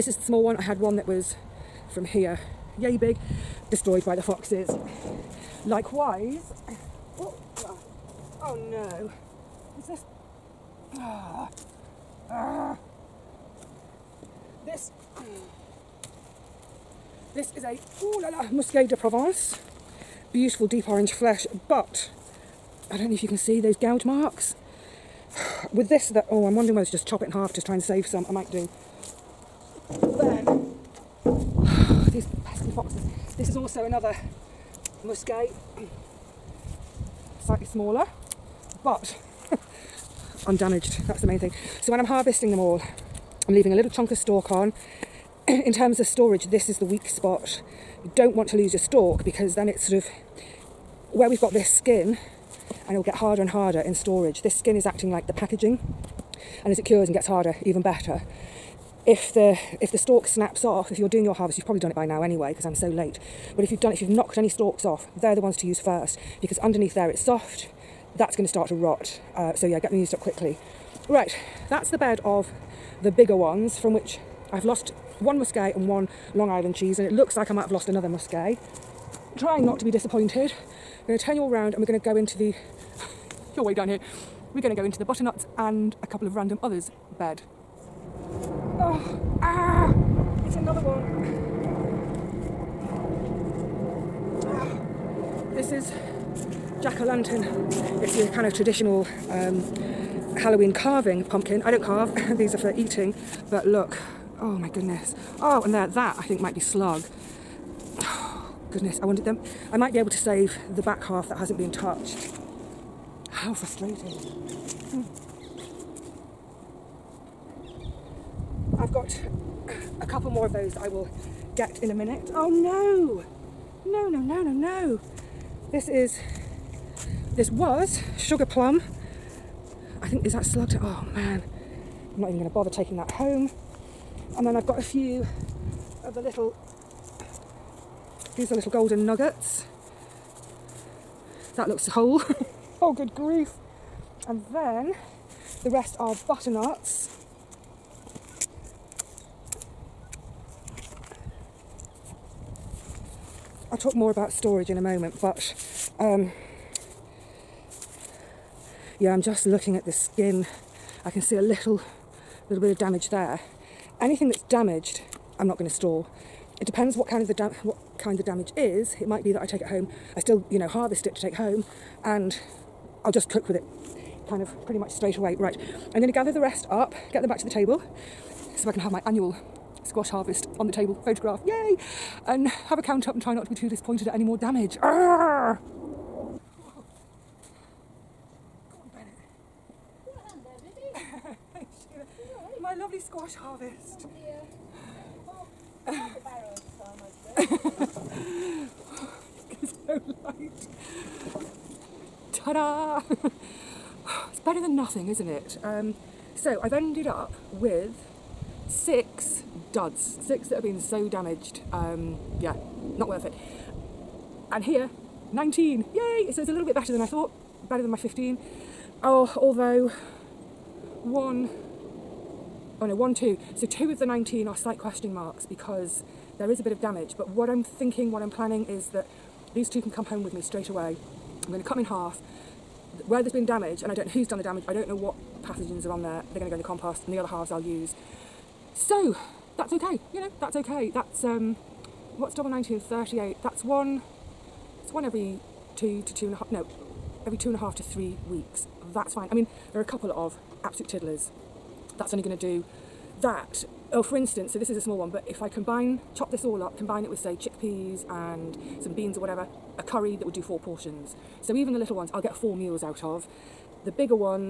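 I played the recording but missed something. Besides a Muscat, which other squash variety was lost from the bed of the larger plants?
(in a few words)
Long Island cheese.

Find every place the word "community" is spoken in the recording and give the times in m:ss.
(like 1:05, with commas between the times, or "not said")
not said.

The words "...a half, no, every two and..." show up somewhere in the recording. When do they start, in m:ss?
4:06.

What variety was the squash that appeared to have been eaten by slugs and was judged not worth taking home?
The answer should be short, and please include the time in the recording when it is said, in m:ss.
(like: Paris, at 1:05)
Sugar plum, at 2:08.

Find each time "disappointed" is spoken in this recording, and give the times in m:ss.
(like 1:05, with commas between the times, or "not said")
1:19, 3:03.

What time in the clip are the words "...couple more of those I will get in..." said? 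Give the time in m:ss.
2:00.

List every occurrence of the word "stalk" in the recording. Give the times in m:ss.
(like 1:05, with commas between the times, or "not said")
0:44, 0:48, 0:59, 1:04.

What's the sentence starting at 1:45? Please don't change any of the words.
Oh, and there, that I think might be slug.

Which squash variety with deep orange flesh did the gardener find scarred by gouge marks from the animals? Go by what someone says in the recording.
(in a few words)
Musquet de Provence.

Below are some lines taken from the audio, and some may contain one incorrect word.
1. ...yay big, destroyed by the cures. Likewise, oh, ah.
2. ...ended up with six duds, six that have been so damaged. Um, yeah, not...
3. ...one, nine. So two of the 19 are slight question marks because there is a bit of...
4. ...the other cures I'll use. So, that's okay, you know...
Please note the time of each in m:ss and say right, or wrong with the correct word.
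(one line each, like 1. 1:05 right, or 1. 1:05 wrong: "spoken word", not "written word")
1. 0:02 wrong: "foxes", not "cures"
2. 3:26 right
3. 3:42 wrong: "two", not "nine"
4. 3:57 wrong: "halves", not "cures".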